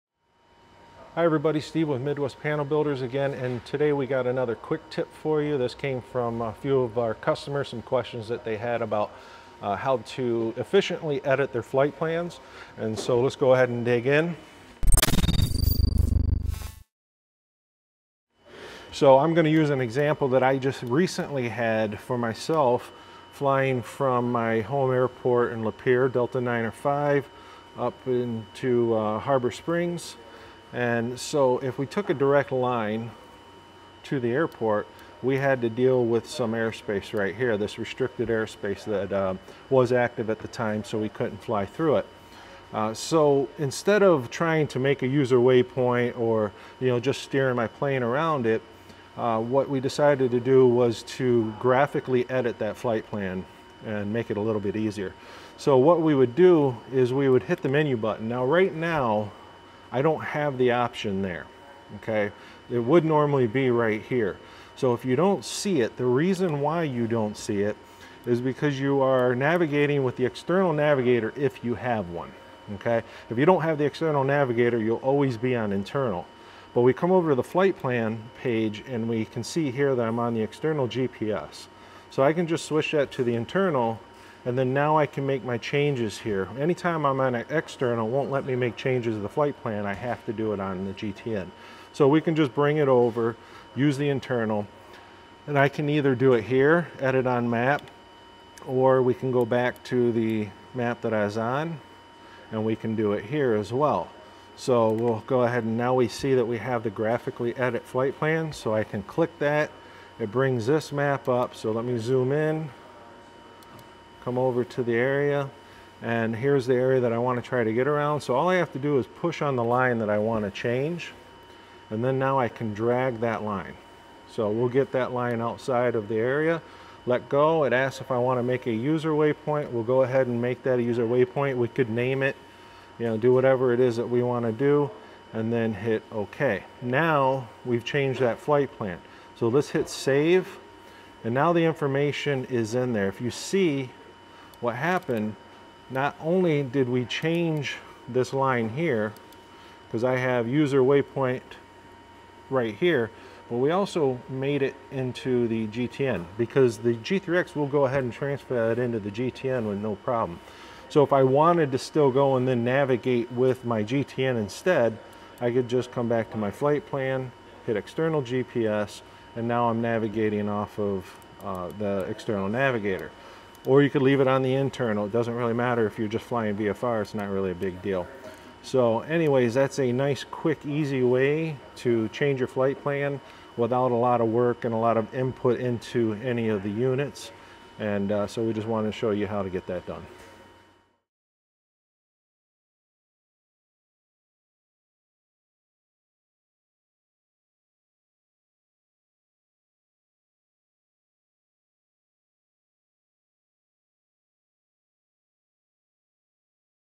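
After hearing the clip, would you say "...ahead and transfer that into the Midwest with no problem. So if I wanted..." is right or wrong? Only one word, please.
wrong.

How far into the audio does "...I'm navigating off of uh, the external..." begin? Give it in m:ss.
2:49.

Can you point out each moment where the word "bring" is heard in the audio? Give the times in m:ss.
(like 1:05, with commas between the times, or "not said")
1:32, 1:50.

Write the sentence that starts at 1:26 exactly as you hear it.
Anytime I'm on an external, won't let me make changes to the flight plan.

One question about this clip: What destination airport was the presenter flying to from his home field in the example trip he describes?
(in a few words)
Harbor Springs.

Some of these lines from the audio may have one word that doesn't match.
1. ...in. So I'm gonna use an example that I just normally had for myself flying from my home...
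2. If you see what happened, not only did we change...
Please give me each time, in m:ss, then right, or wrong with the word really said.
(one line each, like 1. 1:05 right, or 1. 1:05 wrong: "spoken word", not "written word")
1. 0:14 wrong: "recently", not "normally"
2. 2:23 right.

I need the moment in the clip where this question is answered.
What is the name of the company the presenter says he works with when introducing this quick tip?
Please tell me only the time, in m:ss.
0:02.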